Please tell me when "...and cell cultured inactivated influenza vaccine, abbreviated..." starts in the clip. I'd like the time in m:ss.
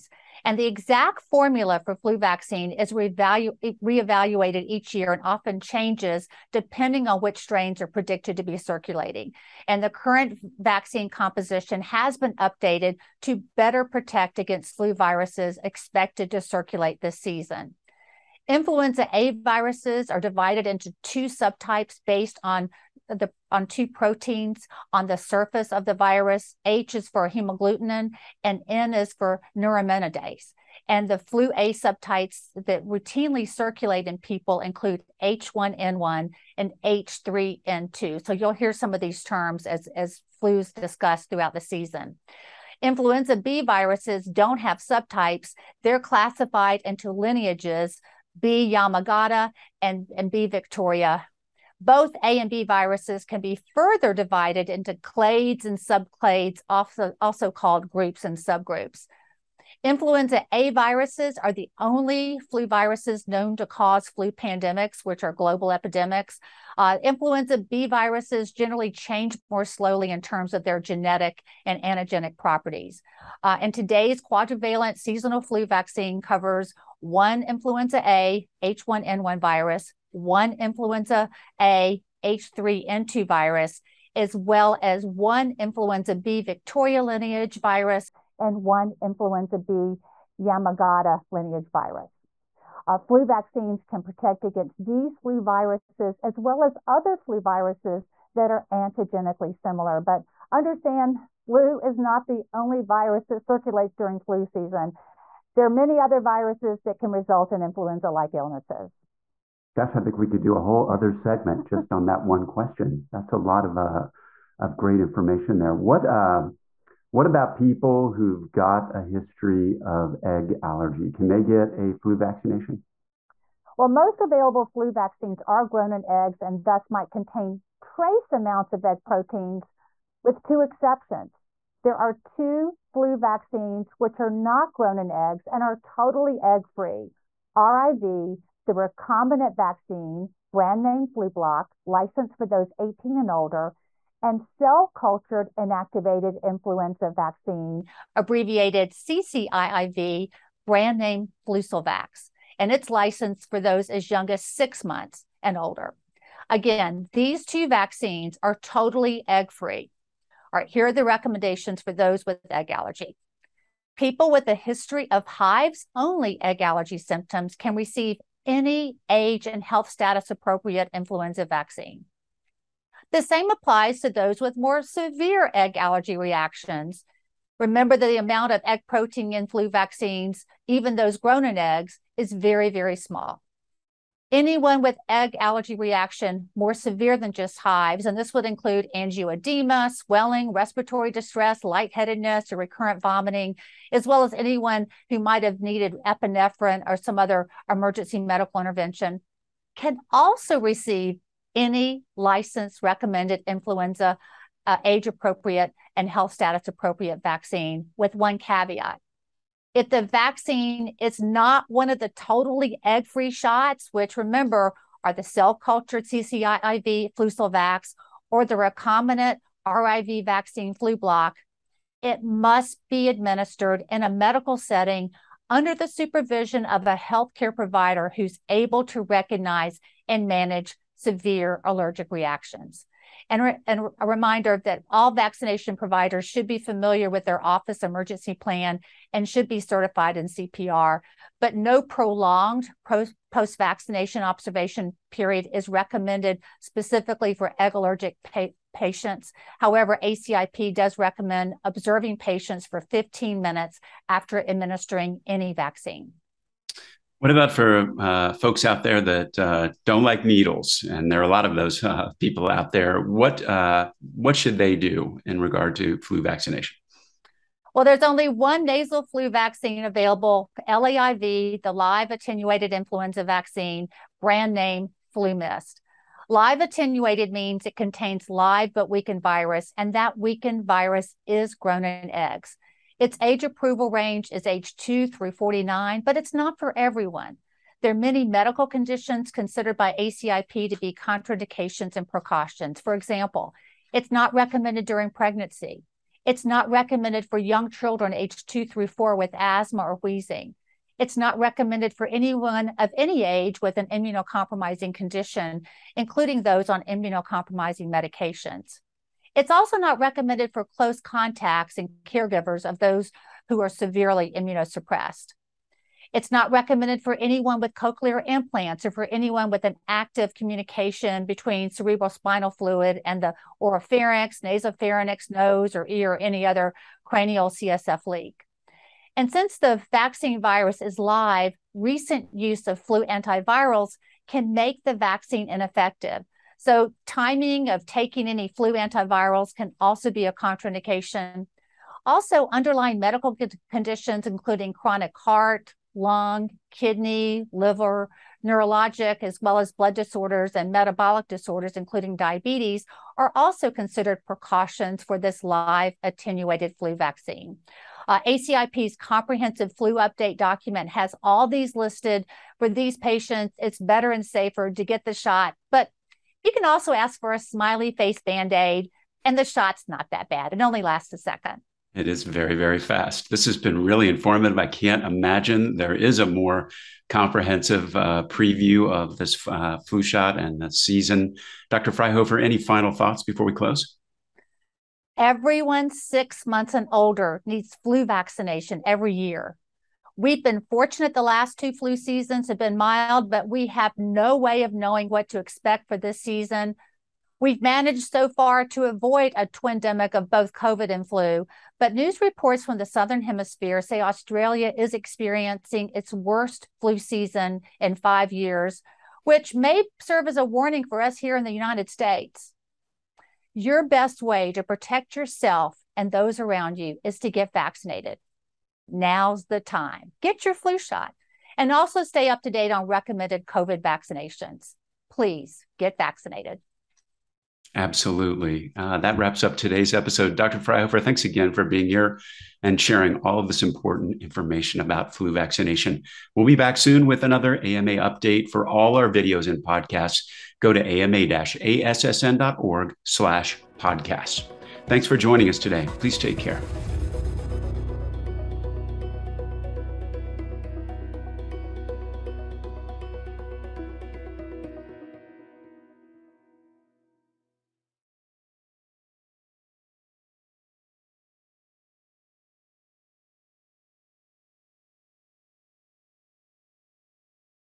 2:24.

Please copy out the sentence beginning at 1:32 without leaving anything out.
Uh, flu vaccines can protect against these flu viruses as well as other flu viruses that are antigenically similar.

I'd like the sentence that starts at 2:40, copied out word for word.
All right, here are the recommendations for those with egg allergy.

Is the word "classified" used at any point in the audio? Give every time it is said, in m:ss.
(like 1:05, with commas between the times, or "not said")
0:45.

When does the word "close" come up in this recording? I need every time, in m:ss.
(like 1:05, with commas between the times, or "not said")
5:10, 6:23.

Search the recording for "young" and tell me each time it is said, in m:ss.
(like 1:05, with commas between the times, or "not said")
2:34, 4:57.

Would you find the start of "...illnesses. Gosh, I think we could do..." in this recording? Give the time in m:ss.
1:48.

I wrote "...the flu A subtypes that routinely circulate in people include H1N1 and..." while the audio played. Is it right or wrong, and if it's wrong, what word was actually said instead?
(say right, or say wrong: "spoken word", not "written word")
right.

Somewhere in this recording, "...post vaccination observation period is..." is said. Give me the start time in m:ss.
4:03.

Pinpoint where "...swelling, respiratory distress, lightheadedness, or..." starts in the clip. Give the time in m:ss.
3:09.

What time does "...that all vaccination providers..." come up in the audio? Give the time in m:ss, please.
3:54.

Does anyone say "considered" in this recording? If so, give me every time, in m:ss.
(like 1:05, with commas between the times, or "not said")
4:49, 5:53.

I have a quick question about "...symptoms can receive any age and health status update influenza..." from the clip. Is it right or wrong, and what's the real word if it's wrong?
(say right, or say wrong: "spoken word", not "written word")
wrong: "appropriate", not "update".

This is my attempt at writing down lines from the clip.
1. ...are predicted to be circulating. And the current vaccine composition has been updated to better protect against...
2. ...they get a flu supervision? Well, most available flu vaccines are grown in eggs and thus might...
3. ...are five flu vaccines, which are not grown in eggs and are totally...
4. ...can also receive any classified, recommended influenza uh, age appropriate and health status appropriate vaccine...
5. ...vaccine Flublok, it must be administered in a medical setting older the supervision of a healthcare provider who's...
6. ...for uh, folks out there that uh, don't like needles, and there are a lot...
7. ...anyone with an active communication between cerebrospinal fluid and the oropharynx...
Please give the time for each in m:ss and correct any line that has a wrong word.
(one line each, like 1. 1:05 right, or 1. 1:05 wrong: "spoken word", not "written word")
1. 0:07 right
2. 2:01 wrong: "vaccination", not "supervision"
3. 2:11 wrong: "two", not "five"
4. 3:19 wrong: "licensed", not "classified"
5. 3:40 wrong: "under", not "older"
6. 4:17 right
7. 5:19 right.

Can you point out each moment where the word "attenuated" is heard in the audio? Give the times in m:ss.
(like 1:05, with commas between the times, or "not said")
4:32, 4:36, 5:56.